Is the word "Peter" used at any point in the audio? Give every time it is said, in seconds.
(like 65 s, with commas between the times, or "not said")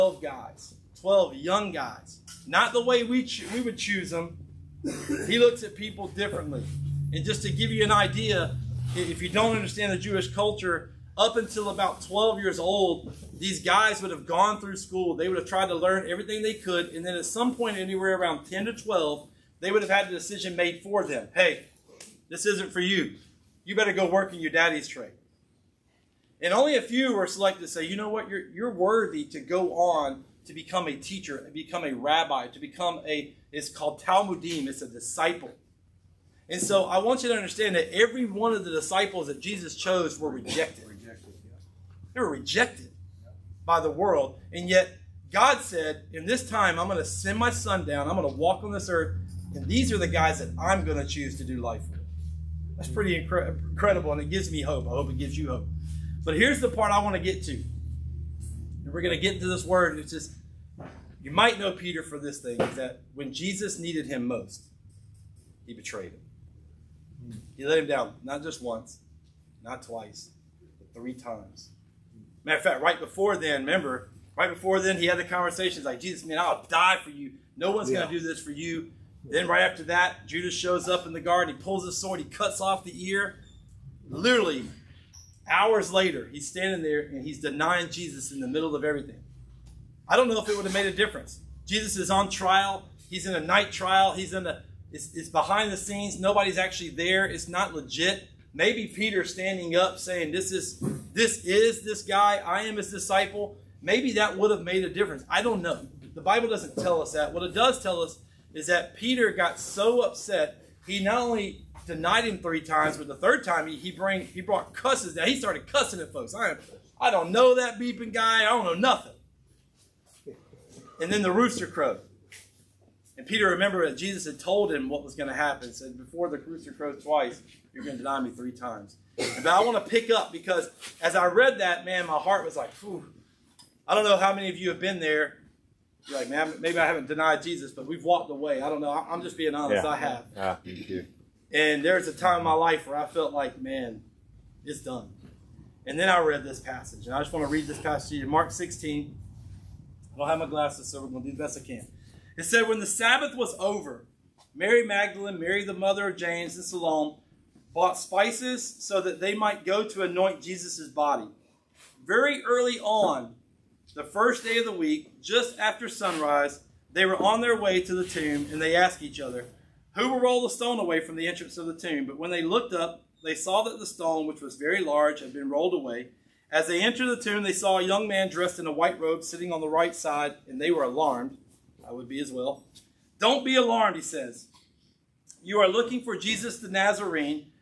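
61 s, 98 s, 108 s, 123 s.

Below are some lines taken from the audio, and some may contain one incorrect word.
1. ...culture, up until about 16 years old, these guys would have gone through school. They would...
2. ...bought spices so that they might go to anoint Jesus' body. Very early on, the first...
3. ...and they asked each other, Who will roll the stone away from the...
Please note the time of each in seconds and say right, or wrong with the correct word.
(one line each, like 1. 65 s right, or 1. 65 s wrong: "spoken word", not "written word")
1. 10 s wrong: "12", not "16"
2. 157 s right
3. 168 s right.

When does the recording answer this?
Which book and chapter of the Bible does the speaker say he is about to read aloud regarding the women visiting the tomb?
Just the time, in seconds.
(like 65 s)
148 s.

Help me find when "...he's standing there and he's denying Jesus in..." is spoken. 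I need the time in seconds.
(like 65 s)
86 s.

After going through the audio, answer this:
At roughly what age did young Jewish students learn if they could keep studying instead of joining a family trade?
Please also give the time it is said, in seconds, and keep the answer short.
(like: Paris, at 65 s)
10 to 12, at 18 s.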